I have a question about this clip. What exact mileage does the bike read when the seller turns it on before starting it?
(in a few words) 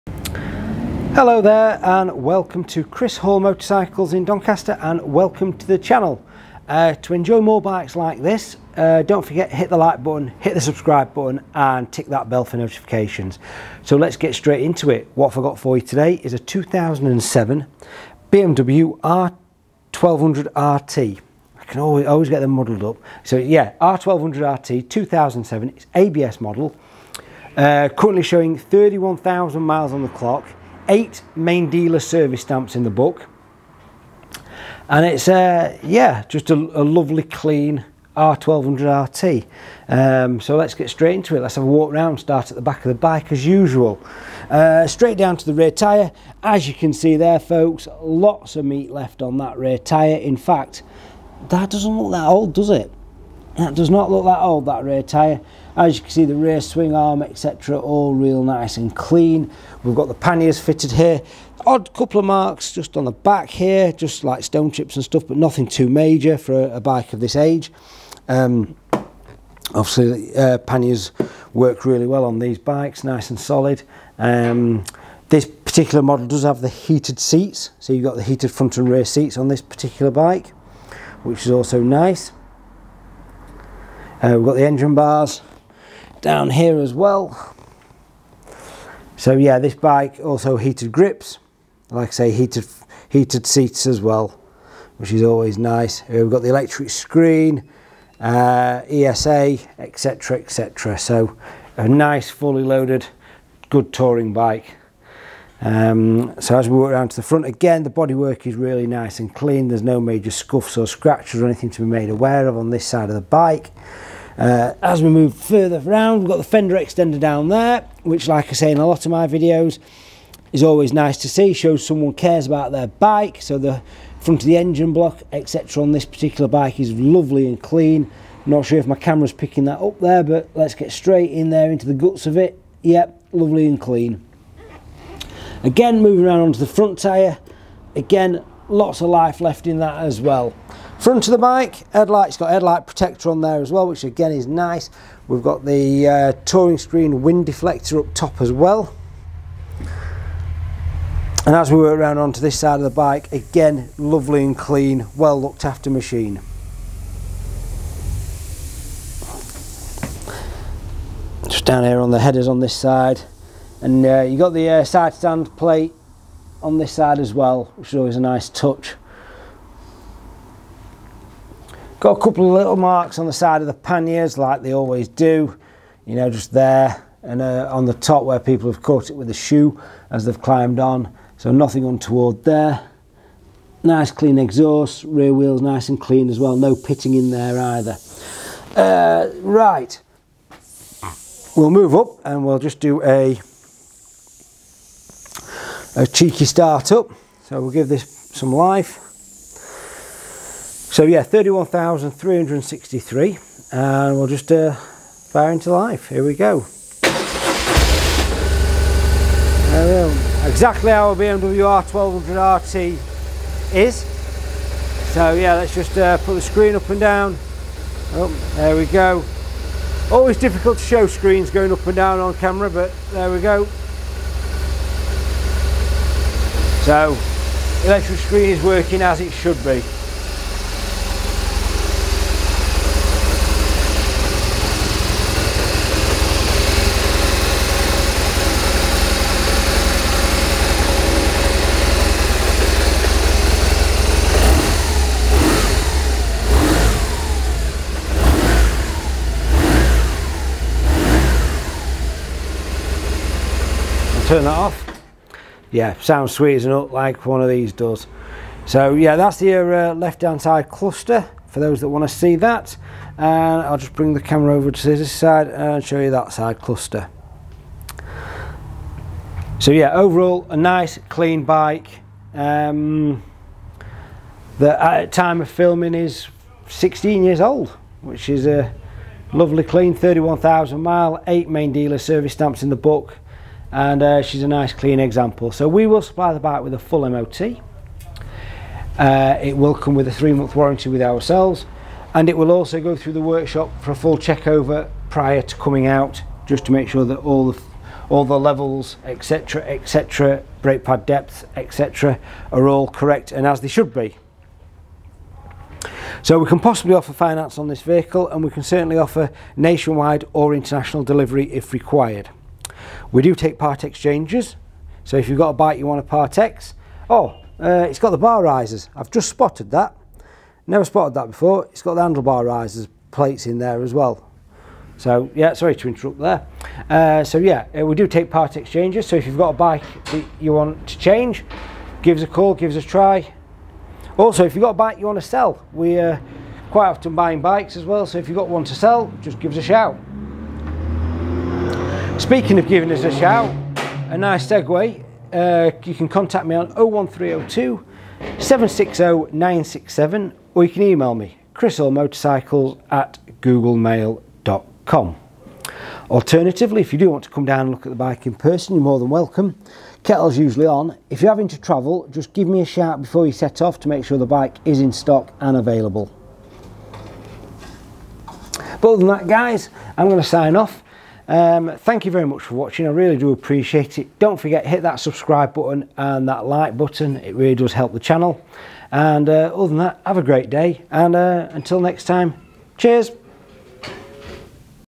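31,363.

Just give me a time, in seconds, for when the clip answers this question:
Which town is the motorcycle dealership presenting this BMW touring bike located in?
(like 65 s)
4 s.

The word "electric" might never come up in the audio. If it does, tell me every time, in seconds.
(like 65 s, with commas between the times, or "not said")
96 s, 227 s.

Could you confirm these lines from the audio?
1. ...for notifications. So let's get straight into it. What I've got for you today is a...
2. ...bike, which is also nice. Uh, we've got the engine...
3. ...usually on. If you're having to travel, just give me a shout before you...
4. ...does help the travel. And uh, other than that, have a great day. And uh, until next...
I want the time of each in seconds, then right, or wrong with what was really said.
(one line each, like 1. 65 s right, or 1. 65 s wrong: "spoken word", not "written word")
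1. 12 s right
2. 80 s right
3. 360 s right
4. 377 s wrong: "channel", not "travel".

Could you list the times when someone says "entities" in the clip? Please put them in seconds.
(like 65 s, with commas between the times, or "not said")
not said.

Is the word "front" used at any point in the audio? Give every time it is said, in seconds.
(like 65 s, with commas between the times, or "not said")
78 s, 107 s, 124 s, 136 s, 141 s.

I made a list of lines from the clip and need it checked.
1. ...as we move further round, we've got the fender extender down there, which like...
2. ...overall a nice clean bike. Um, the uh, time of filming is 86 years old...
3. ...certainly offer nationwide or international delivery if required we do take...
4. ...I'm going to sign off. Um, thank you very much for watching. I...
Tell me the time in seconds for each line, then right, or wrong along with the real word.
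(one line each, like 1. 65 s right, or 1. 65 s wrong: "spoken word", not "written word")
1. 114 s right
2. 269 s wrong: "16", not "86"
3. 308 s right
4. 369 s right.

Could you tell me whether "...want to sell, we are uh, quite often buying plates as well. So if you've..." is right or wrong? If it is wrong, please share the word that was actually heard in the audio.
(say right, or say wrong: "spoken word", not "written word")
wrong: "bikes", not "plates".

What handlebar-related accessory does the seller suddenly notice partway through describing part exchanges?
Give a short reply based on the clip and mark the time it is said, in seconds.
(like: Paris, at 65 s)
bar risers, at 318 s.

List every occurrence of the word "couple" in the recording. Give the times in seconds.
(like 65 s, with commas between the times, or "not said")
61 s, 172 s.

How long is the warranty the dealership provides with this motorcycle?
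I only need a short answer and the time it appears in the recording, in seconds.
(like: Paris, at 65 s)
3 months, at 290 s.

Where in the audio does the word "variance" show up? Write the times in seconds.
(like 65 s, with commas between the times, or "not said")
not said.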